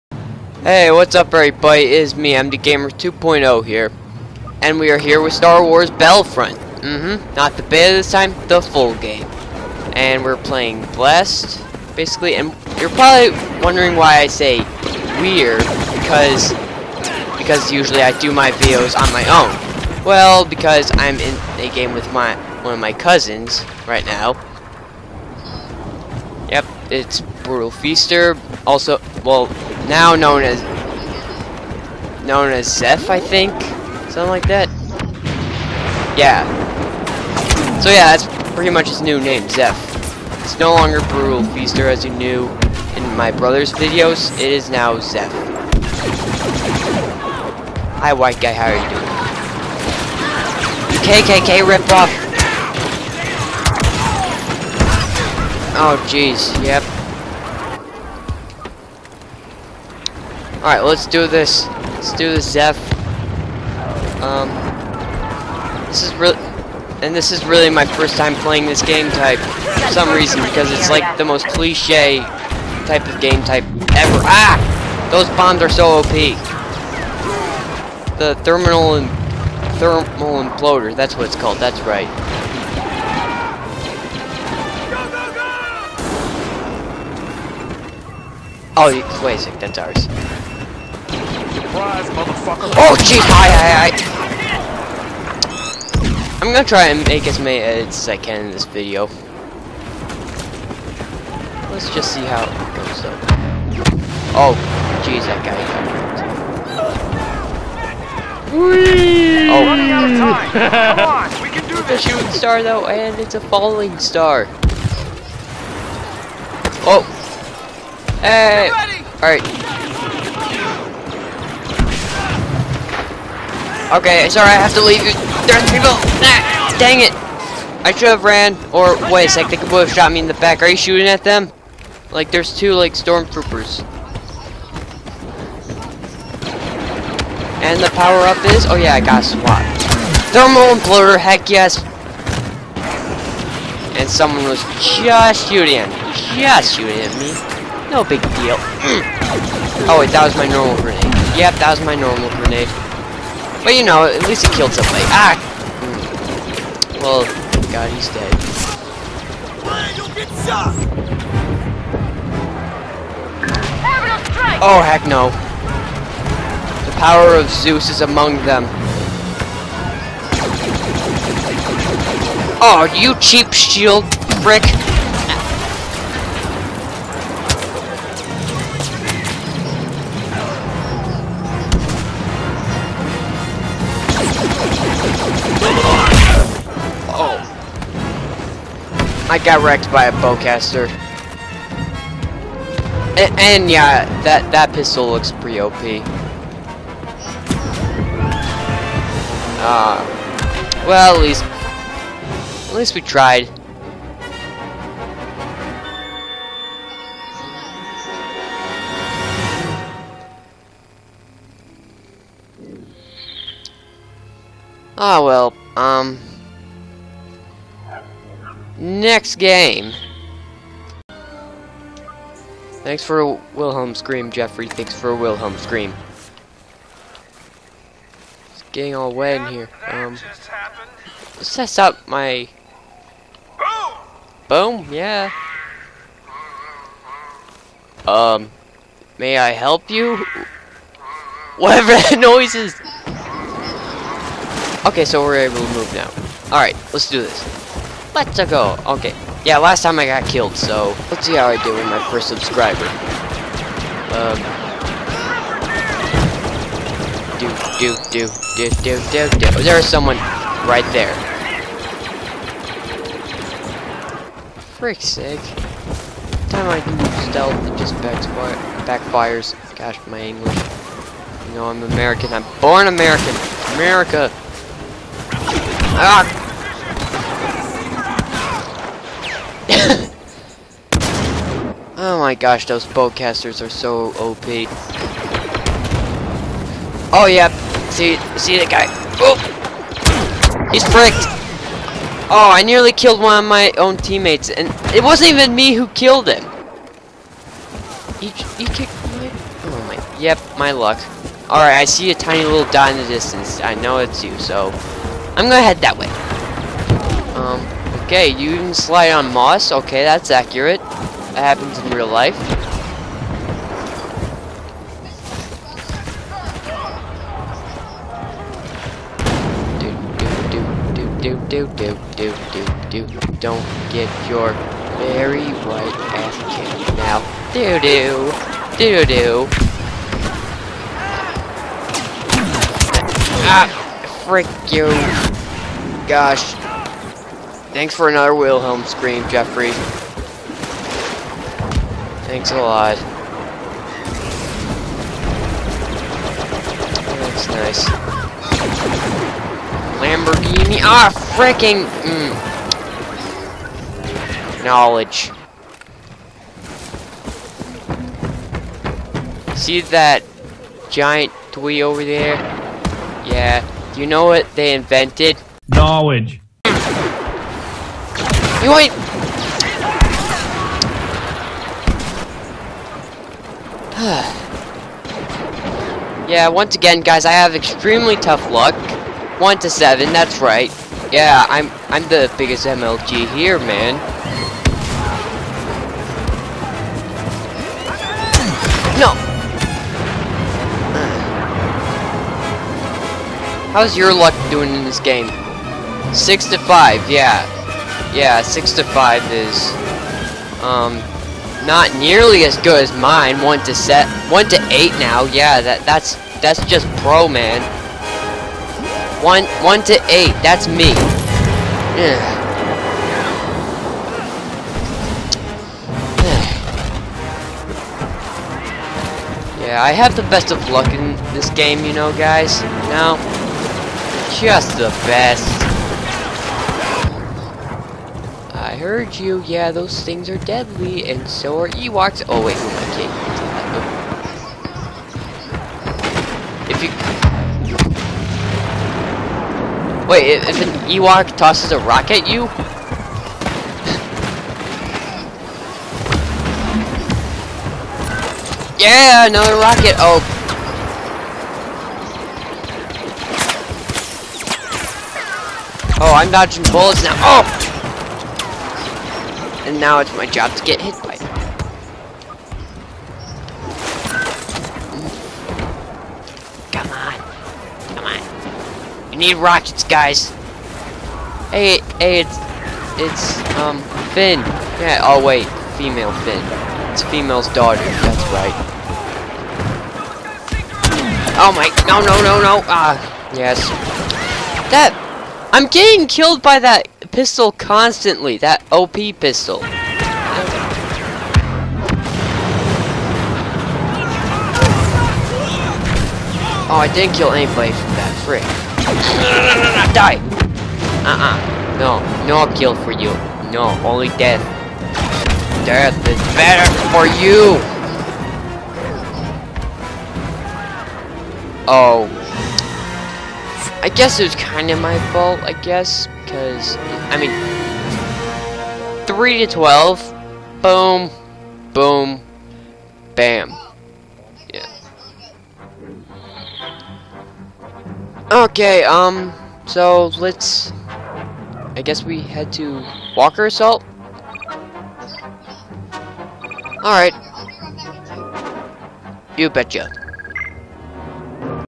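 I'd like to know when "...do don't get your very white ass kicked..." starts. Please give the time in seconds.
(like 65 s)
322 s.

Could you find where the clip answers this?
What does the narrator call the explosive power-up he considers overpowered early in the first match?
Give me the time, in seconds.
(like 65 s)
79 s.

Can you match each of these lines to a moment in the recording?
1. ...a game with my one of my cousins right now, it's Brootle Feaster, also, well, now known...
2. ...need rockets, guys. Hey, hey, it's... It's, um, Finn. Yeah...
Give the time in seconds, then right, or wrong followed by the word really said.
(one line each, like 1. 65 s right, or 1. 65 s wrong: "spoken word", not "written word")
1. 21 s right
2. 469 s right.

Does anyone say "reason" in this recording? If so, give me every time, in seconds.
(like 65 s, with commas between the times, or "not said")
70 s.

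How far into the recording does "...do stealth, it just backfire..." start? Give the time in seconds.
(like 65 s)
266 s.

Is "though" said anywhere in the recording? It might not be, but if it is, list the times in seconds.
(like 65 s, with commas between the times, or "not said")
112 s.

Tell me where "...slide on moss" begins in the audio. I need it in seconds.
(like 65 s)
308 s.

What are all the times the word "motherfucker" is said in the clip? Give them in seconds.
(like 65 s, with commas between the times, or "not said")
92 s.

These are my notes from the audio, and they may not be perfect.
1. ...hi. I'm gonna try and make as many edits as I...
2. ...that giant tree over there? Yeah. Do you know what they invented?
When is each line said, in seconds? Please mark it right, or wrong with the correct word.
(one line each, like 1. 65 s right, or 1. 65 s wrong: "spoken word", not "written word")
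1. 95 s right
2. 359 s right.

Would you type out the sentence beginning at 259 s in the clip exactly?
Oh, there is someone right there.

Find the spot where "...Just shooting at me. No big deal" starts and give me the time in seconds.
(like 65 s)
146 s.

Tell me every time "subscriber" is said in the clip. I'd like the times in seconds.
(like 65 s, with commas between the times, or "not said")
252 s.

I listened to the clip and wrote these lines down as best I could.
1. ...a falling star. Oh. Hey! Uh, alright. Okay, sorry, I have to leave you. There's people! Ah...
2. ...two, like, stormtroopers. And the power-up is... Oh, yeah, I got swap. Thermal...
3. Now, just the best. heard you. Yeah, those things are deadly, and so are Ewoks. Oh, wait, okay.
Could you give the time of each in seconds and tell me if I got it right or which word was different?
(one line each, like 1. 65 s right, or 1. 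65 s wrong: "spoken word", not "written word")
1. 113 s right
2. 132 s right
3. 422 s right.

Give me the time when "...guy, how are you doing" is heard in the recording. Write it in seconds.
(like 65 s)
48 s.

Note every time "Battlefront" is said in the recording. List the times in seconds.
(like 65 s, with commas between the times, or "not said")
5 s.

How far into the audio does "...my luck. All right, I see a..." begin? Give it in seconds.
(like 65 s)
300 s.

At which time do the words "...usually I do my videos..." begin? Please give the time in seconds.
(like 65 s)
17 s.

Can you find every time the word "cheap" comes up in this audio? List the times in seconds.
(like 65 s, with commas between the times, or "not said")
173 s.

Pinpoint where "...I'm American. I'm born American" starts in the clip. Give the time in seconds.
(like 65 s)
271 s.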